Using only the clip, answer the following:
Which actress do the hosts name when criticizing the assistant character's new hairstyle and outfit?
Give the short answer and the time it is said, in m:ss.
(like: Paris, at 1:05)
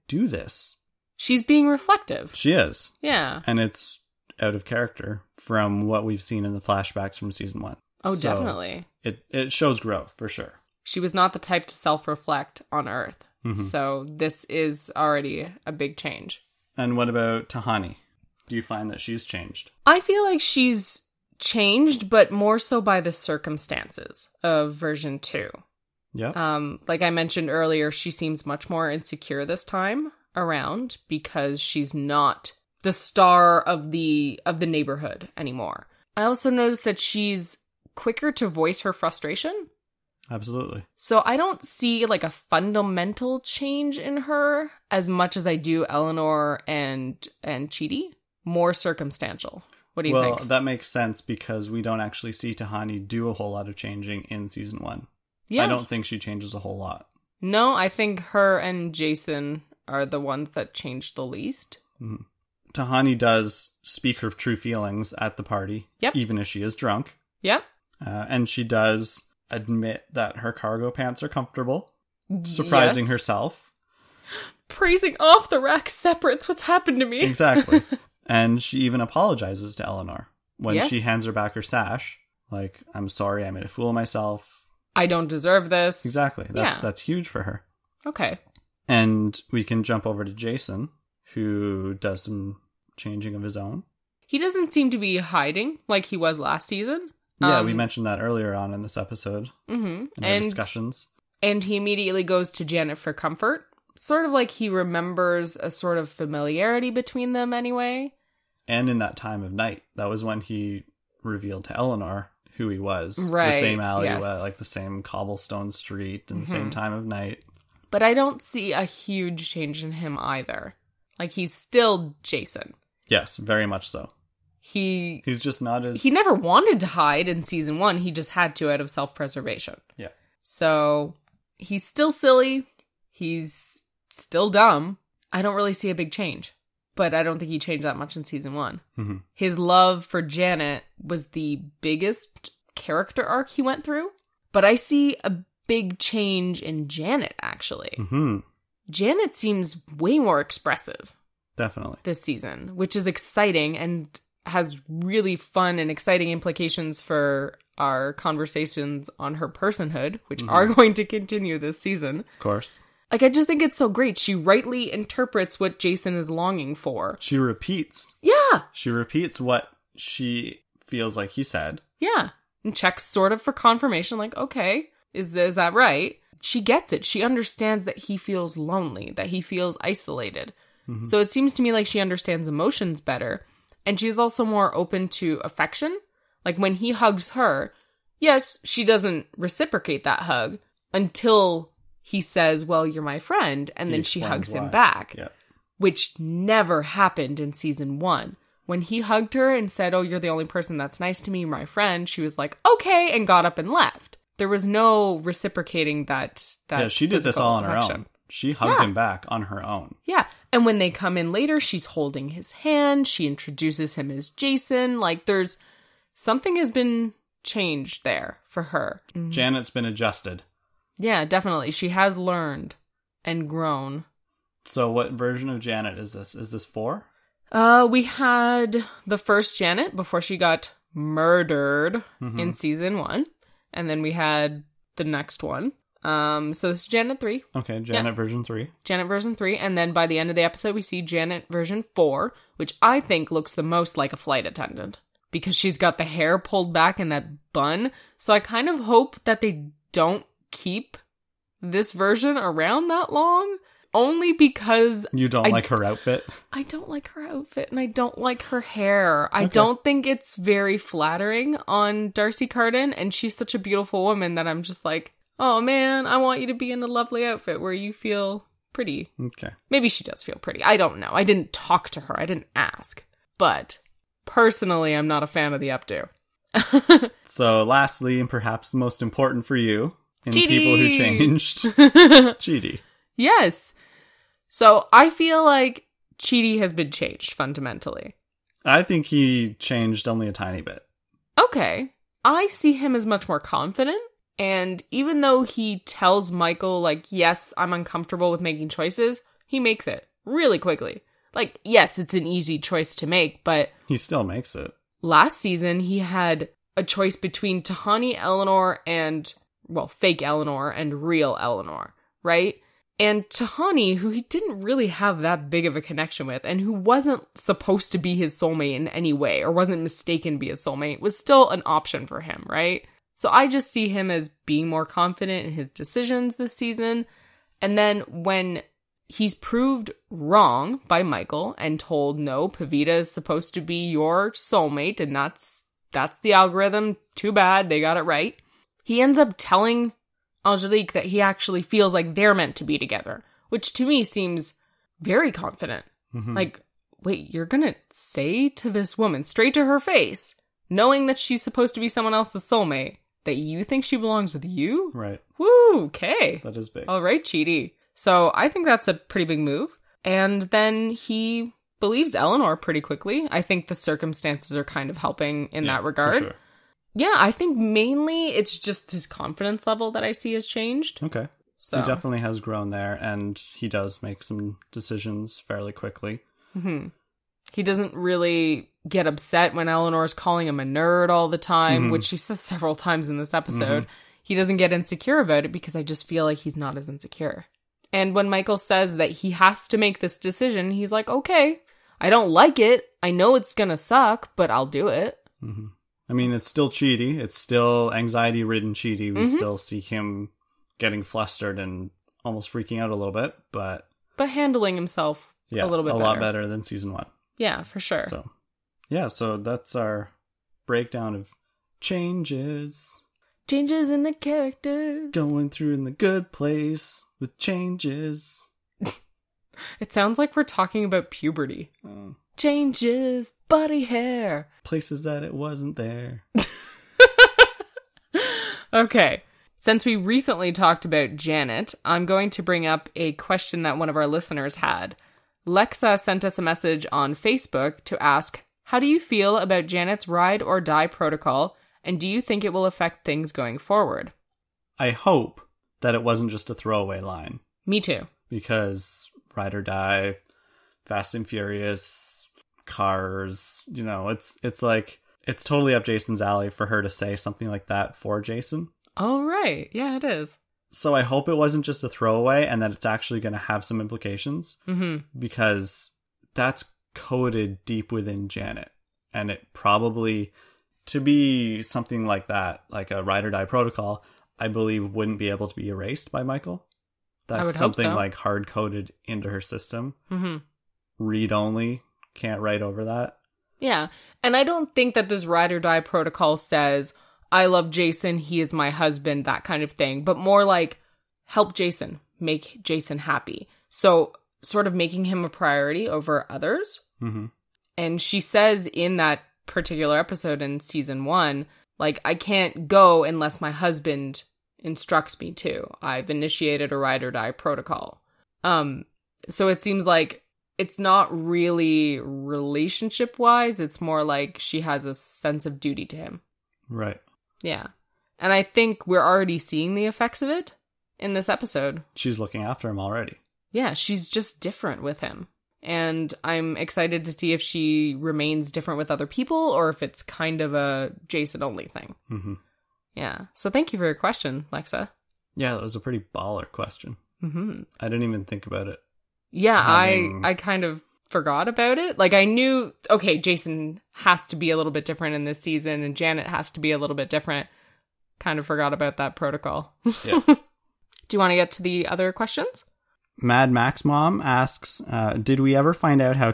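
D'Arcy Carden, at 4:22.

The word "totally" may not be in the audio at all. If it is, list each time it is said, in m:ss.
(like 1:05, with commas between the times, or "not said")
7:35.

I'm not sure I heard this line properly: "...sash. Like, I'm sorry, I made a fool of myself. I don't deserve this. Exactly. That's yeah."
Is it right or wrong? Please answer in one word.
right.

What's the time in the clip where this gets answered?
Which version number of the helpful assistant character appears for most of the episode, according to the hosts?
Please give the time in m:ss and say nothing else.
3:56.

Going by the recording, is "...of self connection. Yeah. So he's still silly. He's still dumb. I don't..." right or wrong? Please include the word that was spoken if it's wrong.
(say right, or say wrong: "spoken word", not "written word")
wrong: "preservation", not "connection".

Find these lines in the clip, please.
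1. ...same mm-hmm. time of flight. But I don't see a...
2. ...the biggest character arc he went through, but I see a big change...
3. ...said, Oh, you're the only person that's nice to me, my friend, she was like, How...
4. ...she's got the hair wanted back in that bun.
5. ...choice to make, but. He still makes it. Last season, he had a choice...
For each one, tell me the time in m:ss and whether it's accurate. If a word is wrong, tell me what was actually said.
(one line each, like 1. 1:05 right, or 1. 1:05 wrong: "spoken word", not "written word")
1. 1:56 wrong: "night", not "flight"
2. 2:21 right
3. 3:19 wrong: "Okay", not "How"
4. 4:05 wrong: "pulled", not "wanted"
5. 5:02 right.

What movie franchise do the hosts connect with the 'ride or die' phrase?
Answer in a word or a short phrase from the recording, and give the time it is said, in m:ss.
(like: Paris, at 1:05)
Fast and Furious, at 7:30.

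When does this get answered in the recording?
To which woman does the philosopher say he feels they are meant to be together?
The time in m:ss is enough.
5:40.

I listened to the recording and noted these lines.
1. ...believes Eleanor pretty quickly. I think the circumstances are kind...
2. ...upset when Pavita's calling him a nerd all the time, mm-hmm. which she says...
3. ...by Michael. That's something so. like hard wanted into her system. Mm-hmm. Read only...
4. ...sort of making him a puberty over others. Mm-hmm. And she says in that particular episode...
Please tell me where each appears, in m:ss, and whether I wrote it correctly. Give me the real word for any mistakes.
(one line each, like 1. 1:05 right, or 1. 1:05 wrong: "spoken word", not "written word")
1. 6:01 right
2. 6:19 wrong: "Eleanor", not "Pavita"
3. 7:56 wrong: "coded", not "wanted"
4. 8:14 wrong: "priority", not "puberty".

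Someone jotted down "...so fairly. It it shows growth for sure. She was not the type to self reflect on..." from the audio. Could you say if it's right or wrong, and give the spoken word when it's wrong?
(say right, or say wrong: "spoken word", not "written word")
wrong: "definitely", not "fairly".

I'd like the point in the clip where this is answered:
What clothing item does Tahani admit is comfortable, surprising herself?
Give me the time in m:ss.
1:10.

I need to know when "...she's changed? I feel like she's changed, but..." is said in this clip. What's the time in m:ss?
0:19.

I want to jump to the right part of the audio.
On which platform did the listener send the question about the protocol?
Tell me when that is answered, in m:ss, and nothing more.
7:17.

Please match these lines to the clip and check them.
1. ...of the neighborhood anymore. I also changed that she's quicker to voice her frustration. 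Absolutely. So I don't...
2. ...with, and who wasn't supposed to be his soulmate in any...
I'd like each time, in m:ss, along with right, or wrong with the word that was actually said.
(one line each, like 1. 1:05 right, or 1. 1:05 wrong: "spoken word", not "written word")
1. 0:34 wrong: "noticed", not "changed"
2. 5:16 right.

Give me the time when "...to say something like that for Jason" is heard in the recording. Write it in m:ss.
7:36.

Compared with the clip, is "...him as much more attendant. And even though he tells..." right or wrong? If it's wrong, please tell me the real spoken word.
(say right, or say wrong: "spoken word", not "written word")
wrong: "confident", not "attendant".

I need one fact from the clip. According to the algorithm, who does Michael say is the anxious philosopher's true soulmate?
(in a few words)
Pavita.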